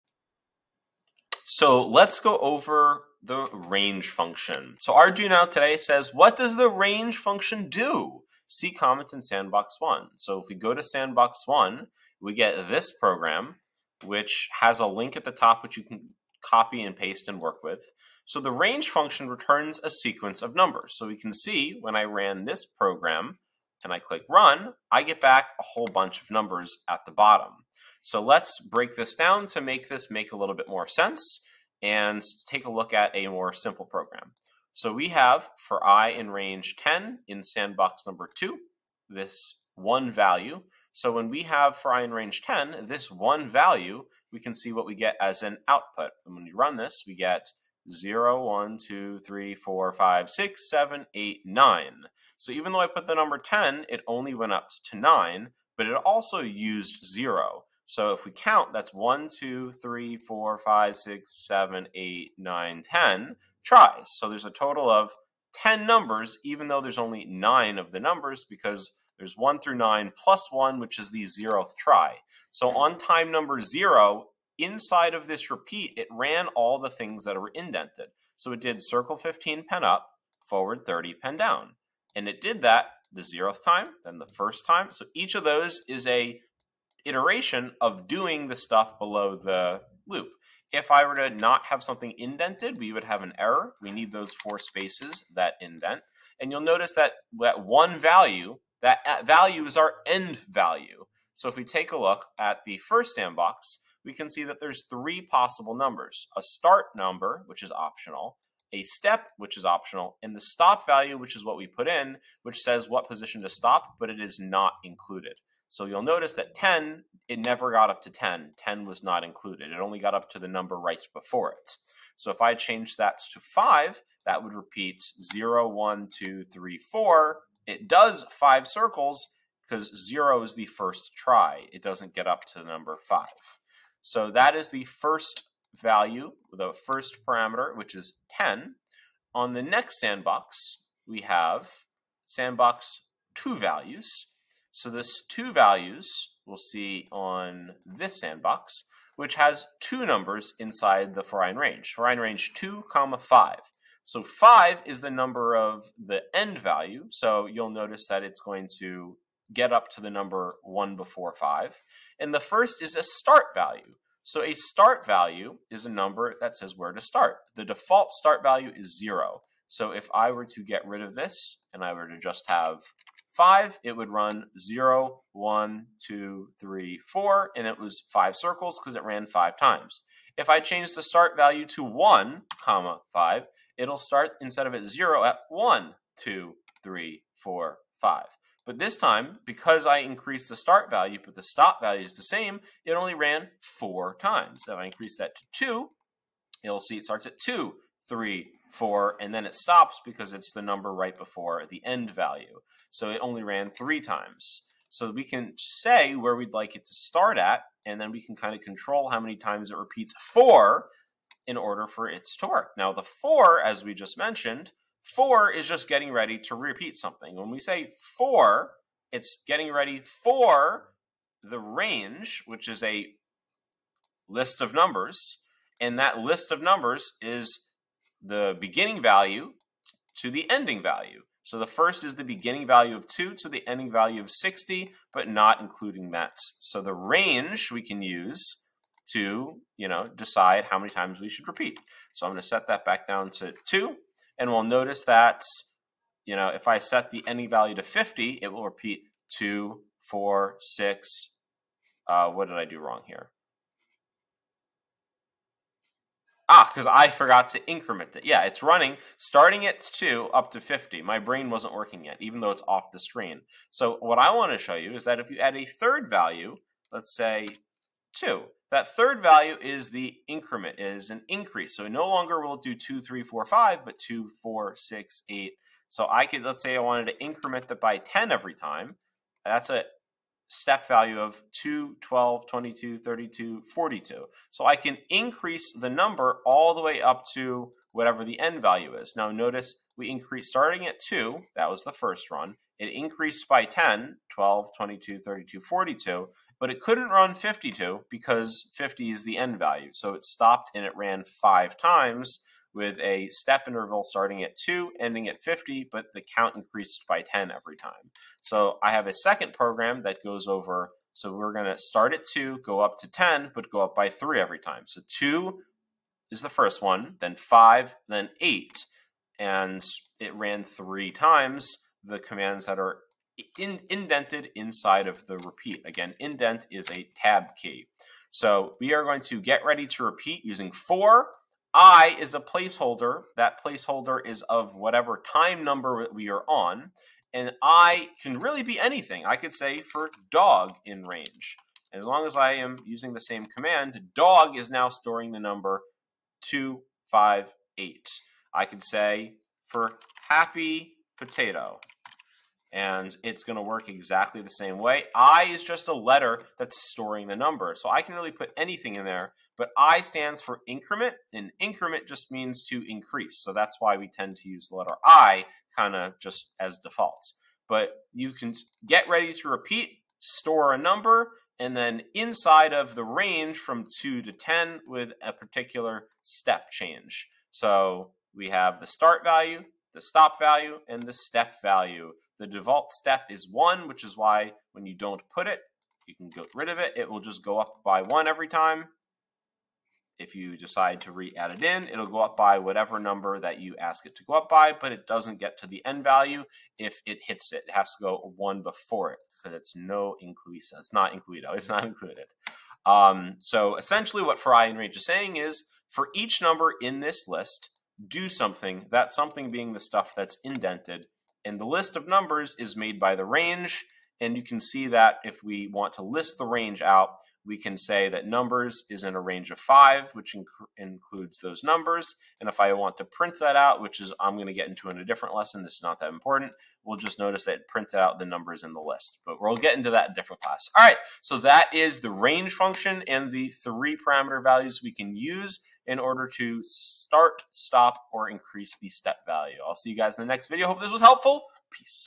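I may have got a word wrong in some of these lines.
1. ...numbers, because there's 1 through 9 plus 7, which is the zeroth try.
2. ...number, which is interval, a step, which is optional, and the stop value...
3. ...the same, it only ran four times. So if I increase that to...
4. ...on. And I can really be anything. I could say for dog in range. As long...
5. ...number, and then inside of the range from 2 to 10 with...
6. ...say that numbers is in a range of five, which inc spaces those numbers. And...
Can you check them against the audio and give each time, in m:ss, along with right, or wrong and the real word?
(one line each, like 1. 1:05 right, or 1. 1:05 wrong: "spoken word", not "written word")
1. 1:07 wrong: "1", not "7"
2. 1:46 wrong: "optional", not "interval"
3. 3:12 right
4. 5:36 right
5. 6:10 right
6. 6:57 wrong: "includes", not "spaces".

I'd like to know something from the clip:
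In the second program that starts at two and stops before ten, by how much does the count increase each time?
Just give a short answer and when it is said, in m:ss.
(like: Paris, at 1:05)
3, at 5:13.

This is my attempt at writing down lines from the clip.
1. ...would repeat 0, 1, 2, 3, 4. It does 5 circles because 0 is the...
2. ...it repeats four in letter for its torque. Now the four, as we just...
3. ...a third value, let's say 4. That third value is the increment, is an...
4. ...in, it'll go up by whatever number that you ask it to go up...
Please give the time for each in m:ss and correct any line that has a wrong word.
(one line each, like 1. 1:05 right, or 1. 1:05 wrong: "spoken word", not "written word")
1. 2:04 right
2. 3:29 wrong: "order", not "letter"
3. 4:25 wrong: "2", not "4"
4. 6:31 right.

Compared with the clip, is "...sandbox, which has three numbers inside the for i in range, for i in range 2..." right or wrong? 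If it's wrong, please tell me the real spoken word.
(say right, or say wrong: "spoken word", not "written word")
wrong: "two", not "three".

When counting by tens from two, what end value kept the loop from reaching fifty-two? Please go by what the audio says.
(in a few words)
50.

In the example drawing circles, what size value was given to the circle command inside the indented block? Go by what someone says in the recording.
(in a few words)
15.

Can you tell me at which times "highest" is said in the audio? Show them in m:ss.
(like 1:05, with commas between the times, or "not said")
not said.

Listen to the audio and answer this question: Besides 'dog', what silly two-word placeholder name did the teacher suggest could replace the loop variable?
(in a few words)
happy potato.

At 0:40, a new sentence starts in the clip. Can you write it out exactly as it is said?
So when we have for i in range 10, this one value, we can see what we get as an output.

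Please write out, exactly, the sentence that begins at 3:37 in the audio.
When we say four, it's getting ready for the range, which is a list of numbers.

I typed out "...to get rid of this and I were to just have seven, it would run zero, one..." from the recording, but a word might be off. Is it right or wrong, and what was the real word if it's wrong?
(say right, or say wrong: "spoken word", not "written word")
wrong: "five", not "seven".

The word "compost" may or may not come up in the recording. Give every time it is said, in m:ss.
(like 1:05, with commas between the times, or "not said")
not said.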